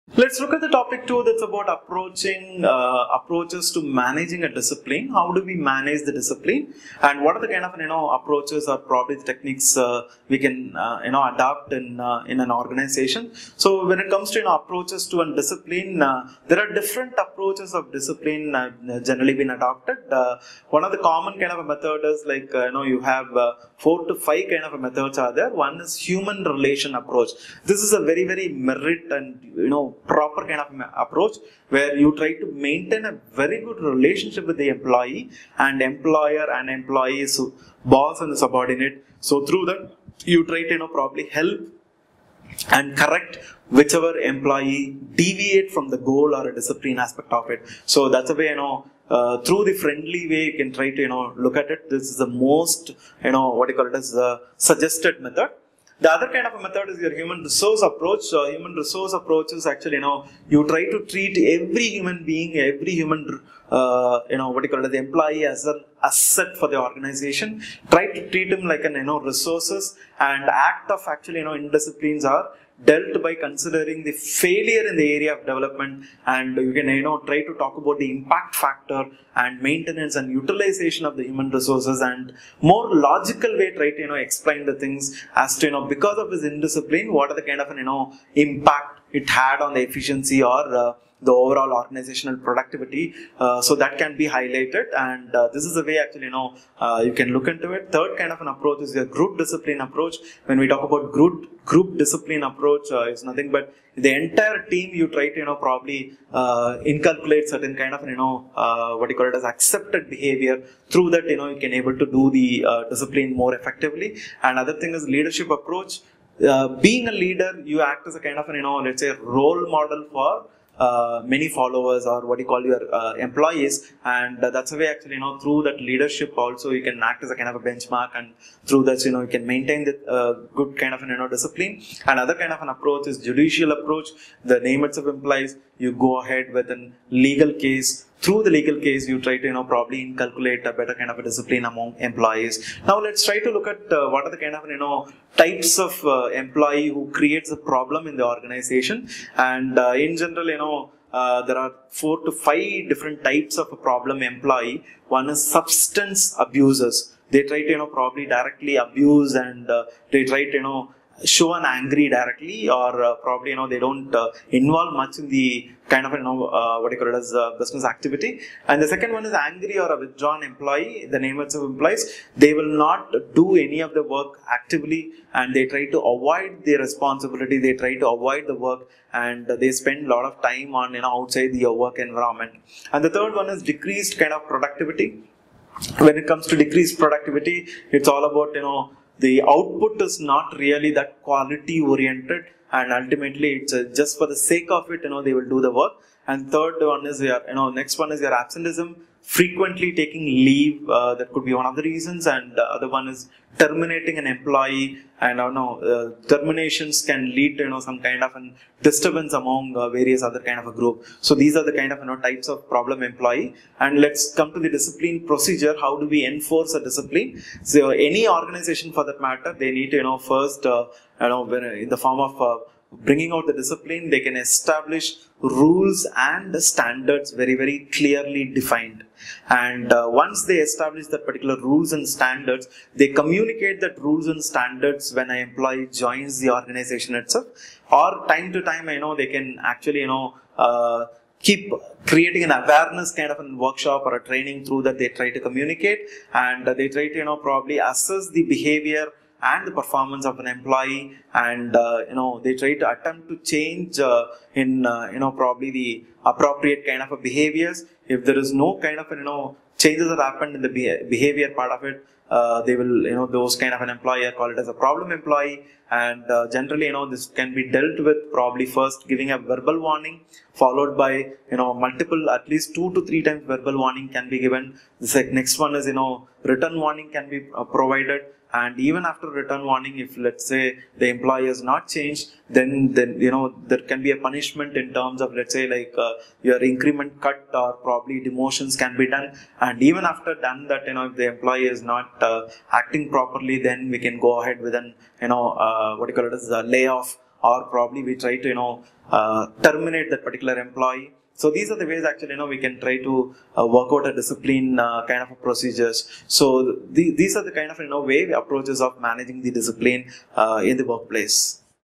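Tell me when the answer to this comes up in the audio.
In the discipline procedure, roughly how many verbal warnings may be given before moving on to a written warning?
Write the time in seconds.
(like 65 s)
272 s.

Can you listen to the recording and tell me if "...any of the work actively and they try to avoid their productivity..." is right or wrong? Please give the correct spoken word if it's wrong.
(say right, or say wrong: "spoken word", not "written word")
wrong: "responsibility", not "productivity".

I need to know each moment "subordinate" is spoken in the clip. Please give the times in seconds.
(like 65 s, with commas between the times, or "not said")
38 s.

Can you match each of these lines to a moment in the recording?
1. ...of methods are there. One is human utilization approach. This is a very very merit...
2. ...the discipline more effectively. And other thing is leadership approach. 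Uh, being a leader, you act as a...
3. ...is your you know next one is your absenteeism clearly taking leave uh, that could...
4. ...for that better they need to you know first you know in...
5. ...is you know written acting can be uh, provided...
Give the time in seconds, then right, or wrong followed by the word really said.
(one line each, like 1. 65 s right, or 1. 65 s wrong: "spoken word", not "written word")
1. 24 s wrong: "relation", not "utilization"
2. 112 s right
3. 197 s wrong: "frequently", not "clearly"
4. 218 s wrong: "matter", not "better"
5. 275 s wrong: "warning", not "acting".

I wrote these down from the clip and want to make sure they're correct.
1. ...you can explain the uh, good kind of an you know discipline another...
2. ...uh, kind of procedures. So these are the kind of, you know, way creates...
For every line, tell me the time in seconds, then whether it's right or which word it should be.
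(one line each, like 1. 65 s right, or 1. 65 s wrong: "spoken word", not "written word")
1. 129 s wrong: "maintain", not "explain"
2. 304 s wrong: "approaches", not "creates".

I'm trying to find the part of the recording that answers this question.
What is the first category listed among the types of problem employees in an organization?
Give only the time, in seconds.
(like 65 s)
155 s.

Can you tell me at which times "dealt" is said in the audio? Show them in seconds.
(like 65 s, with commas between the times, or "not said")
72 s, 267 s.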